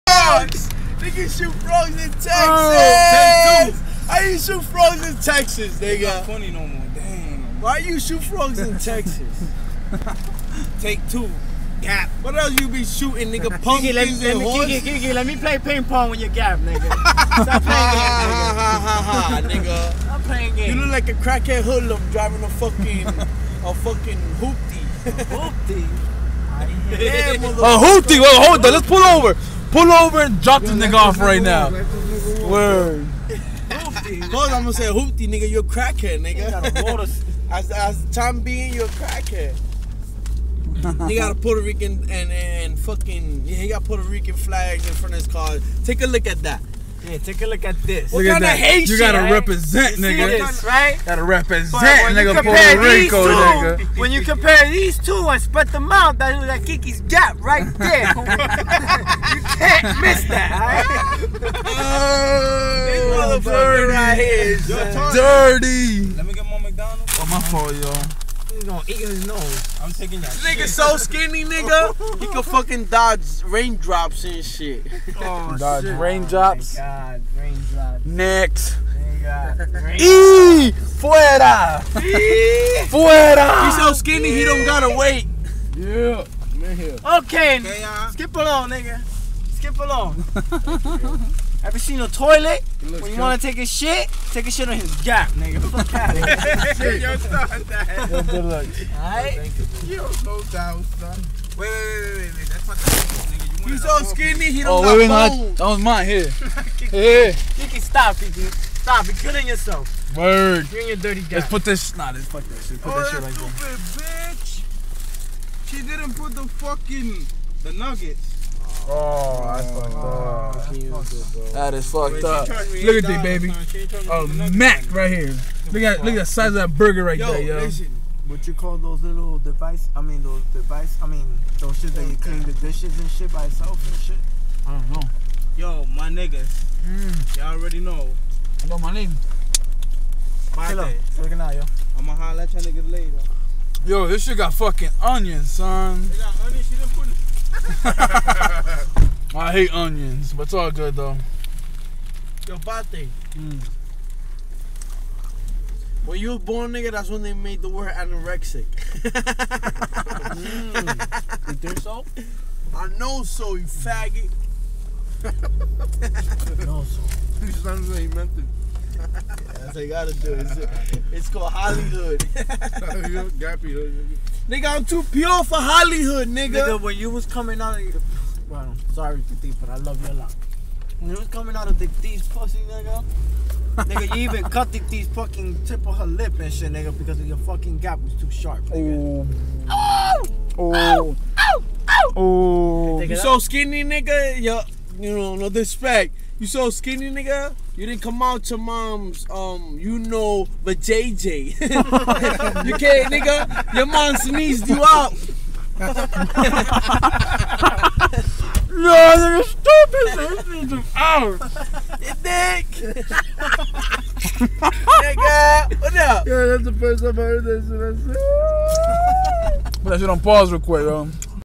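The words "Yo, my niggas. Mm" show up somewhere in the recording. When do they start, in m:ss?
2:15.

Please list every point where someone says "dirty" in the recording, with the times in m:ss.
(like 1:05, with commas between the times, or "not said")
1:05, 1:50.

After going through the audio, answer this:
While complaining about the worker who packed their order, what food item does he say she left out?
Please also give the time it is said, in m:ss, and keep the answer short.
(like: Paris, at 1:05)
Nuggets, at 1:57.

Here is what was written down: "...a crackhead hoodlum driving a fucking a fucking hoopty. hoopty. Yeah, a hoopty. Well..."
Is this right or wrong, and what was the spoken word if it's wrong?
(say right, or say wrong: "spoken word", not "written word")
right.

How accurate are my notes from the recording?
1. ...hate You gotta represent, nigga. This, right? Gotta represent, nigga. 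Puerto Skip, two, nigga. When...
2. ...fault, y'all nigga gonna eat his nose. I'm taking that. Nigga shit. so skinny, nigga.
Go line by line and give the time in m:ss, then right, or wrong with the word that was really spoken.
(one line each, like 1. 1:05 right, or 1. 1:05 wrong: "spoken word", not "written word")
1. 0:48 wrong: "Rico", not "Skip"
2. 1:07 right.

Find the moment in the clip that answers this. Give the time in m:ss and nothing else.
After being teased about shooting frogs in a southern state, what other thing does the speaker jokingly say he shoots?
0:13.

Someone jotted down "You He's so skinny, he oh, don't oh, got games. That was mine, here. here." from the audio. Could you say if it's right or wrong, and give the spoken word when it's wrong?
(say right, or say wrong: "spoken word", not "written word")
wrong: "bones", not "games".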